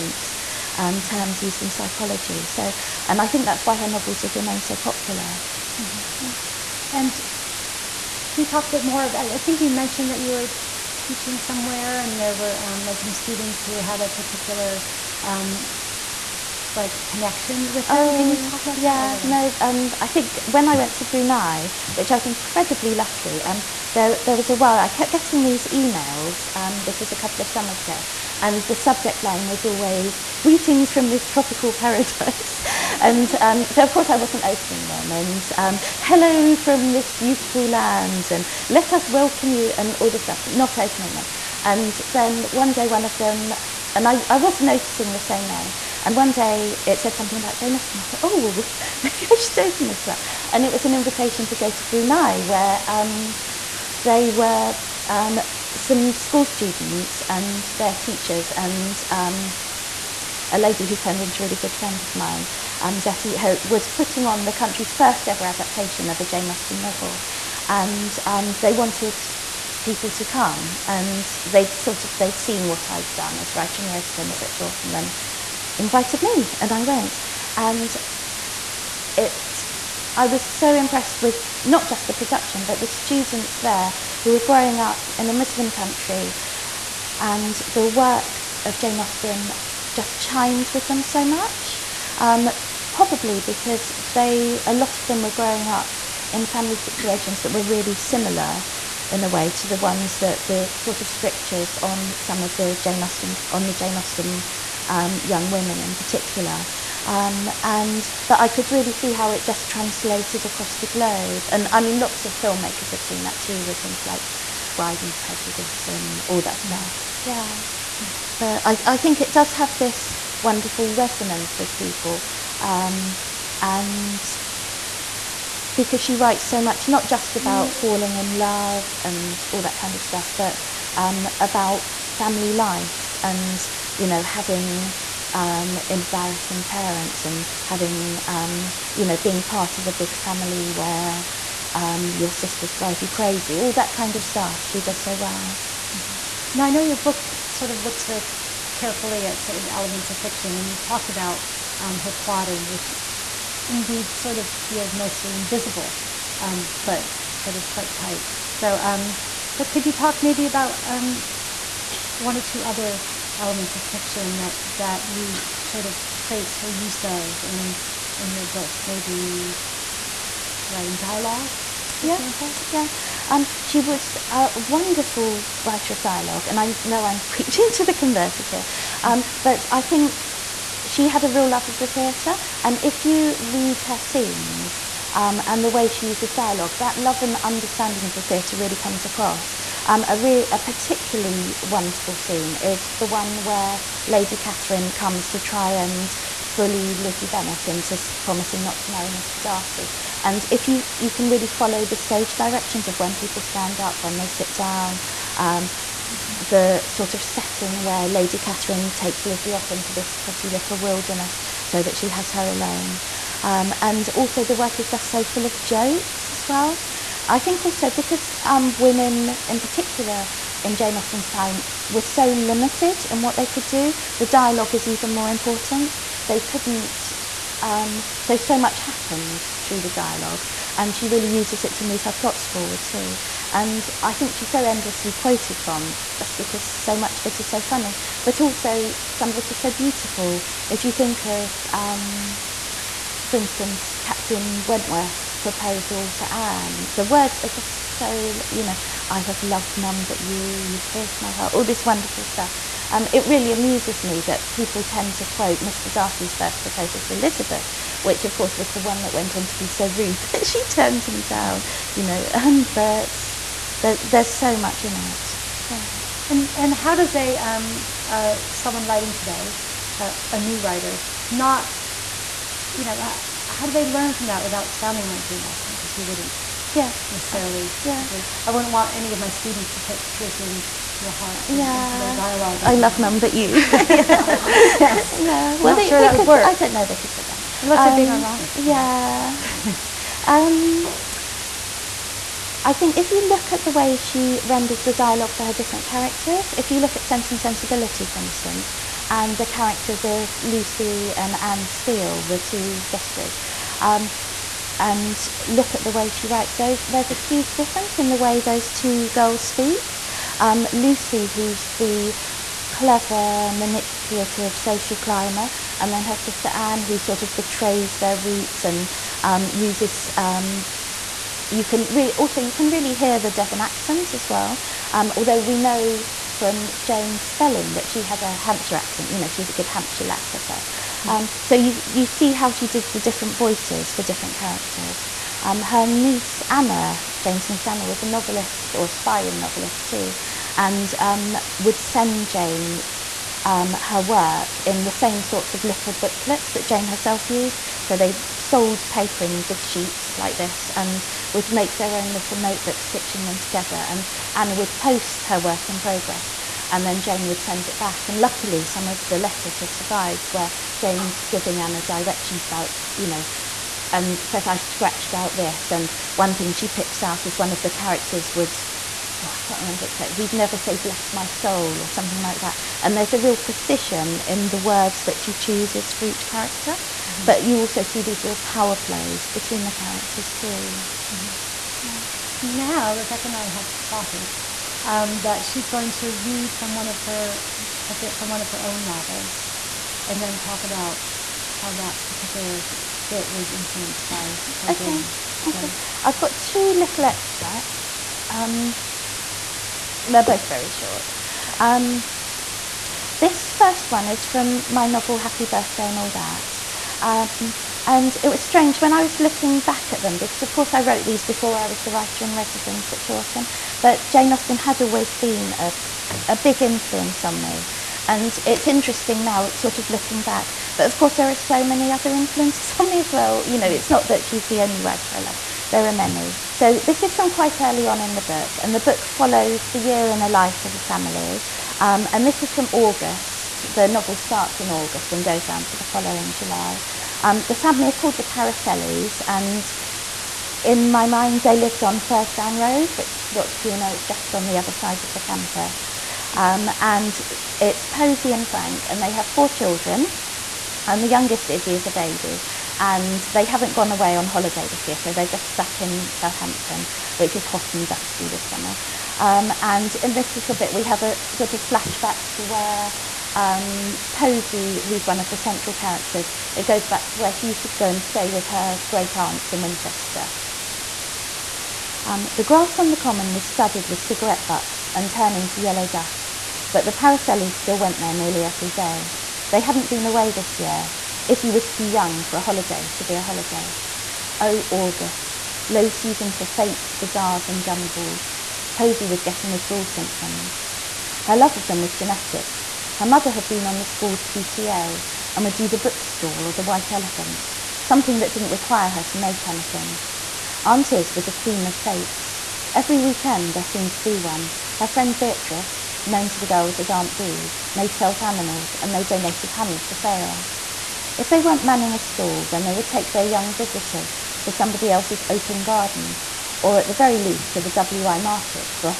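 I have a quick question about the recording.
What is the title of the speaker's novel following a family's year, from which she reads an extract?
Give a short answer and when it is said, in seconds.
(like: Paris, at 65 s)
Happy Birthday and All That, at 405 s.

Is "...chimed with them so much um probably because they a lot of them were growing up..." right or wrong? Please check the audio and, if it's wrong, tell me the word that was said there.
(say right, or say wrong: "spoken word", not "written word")
right.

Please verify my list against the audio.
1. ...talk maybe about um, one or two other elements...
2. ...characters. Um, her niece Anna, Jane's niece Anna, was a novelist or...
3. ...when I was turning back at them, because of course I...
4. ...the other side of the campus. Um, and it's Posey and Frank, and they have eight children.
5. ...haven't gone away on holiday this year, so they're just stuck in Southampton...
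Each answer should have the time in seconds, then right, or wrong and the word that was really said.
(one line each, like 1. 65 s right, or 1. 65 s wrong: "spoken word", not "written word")
1. 159 s right
2. 334 s right
3. 408 s wrong: "looking", not "turning"
4. 444 s wrong: "four", not "eight"
5. 453 s right.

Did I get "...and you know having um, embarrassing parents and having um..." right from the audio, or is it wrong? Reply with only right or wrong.
right.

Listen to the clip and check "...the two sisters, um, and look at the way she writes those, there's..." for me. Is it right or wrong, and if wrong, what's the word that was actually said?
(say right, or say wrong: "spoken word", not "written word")
right.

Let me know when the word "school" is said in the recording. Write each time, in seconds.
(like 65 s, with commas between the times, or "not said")
56 s, 493 s.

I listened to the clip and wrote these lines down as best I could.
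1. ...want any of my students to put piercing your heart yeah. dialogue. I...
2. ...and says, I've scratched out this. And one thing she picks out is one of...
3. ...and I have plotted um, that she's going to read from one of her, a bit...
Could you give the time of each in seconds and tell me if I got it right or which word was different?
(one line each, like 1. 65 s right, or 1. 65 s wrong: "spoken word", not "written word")
1. 278 s right
2. 363 s right
3. 383 s right.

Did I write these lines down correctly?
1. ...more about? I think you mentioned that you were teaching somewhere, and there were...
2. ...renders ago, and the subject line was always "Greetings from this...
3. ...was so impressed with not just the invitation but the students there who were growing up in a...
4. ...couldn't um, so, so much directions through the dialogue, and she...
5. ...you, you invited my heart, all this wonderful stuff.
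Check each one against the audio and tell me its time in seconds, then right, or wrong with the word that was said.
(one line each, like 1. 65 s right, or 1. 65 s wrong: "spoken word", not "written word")
1. 8 s right
2. 27 s wrong: "summers", not "renders"
3. 80 s wrong: "production", not "invitation"
4. 226 s wrong: "happens", not "directions"
5. 250 s wrong: "pierced", not "invited".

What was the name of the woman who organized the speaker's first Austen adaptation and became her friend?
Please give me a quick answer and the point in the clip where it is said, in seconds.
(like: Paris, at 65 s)
Zeti, at 62 s.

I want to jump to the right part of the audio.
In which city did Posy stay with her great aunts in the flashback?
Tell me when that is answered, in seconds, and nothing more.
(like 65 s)
469 s.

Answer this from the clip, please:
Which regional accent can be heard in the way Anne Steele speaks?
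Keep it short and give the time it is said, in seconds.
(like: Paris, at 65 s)
Devon, at 323 s.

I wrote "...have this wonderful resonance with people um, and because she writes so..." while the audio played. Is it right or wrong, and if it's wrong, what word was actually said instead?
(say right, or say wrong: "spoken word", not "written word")
right.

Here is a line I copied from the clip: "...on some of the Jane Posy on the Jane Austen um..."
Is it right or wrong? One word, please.
wrong.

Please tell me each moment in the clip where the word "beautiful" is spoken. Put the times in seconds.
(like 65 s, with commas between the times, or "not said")
37 s, 239 s.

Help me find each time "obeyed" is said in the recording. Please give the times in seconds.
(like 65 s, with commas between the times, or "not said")
not said.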